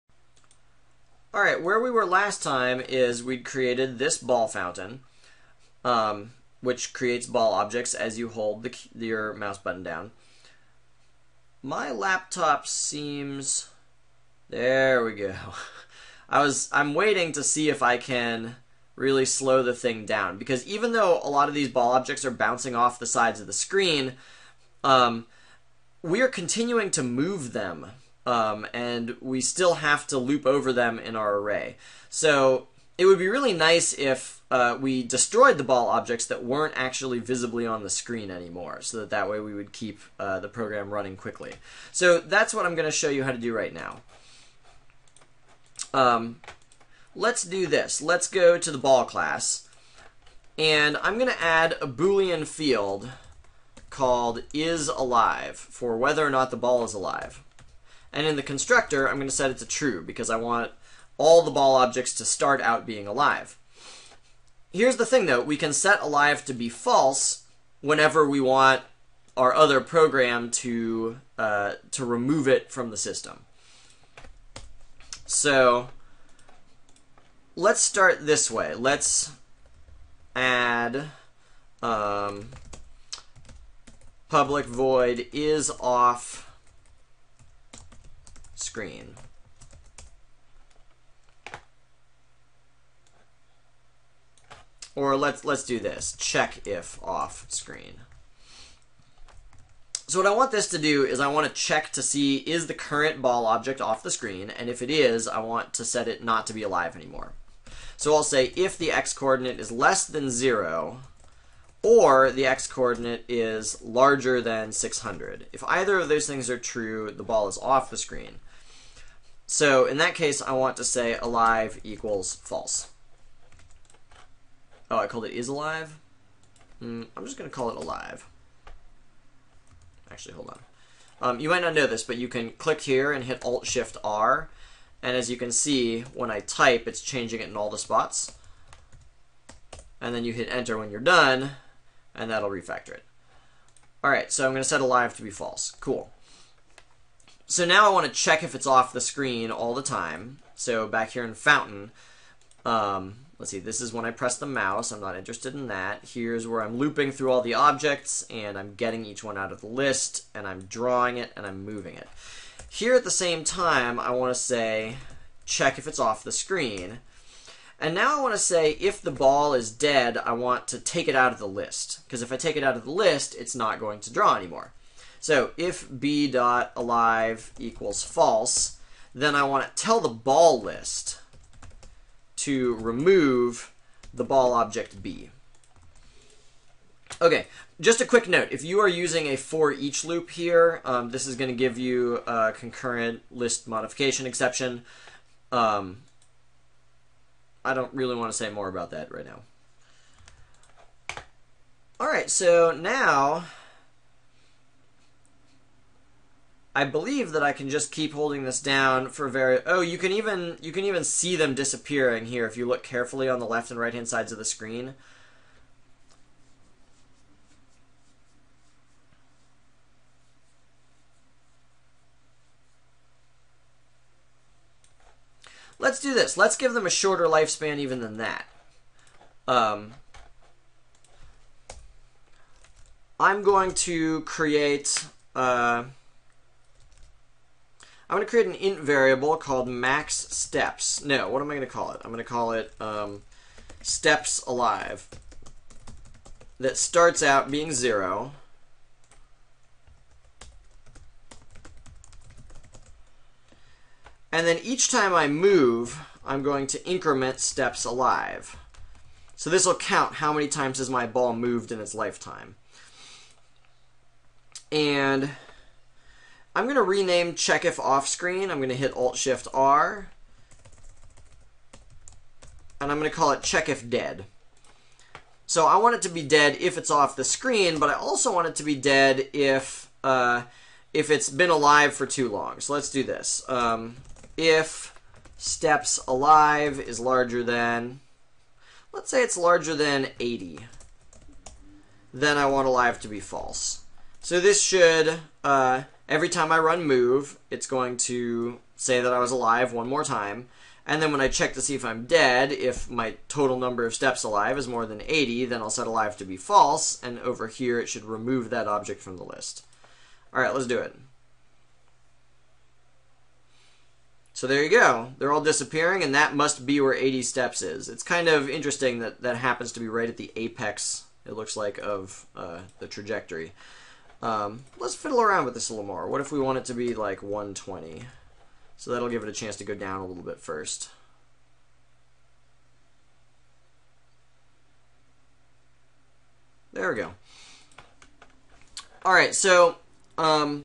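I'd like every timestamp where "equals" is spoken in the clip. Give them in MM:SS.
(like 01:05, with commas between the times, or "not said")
02:01, 02:57.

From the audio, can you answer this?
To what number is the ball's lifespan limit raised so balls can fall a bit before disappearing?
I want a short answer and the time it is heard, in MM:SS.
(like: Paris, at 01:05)
120, at 05:27.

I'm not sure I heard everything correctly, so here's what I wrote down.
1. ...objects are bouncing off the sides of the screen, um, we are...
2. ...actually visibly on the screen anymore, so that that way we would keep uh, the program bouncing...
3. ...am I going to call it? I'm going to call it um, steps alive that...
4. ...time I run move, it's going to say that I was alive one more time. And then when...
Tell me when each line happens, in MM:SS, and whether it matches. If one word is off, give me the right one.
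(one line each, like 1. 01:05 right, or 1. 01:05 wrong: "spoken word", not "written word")
1. 00:21 right
2. 00:36 wrong: "running", not "bouncing"
3. 04:01 right
4. 04:56 right.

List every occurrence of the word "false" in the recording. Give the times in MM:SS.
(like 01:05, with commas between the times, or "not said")
01:06, 02:02, 02:25, 02:58, 04:53, 05:06.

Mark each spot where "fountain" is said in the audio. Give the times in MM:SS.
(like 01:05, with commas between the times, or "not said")
00:04, 02:31.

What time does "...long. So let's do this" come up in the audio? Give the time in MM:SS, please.
04:42.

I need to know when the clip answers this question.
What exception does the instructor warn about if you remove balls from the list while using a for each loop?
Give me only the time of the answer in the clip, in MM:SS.
03:12.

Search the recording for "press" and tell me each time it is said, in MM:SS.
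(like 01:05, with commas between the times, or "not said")
02:34.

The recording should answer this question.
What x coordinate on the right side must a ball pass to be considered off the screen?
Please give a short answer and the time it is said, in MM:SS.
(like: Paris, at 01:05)
600, at 01:54.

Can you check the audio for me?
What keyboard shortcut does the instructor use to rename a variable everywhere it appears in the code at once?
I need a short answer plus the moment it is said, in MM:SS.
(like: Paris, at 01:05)
Alt-Shift-R, at 02:13.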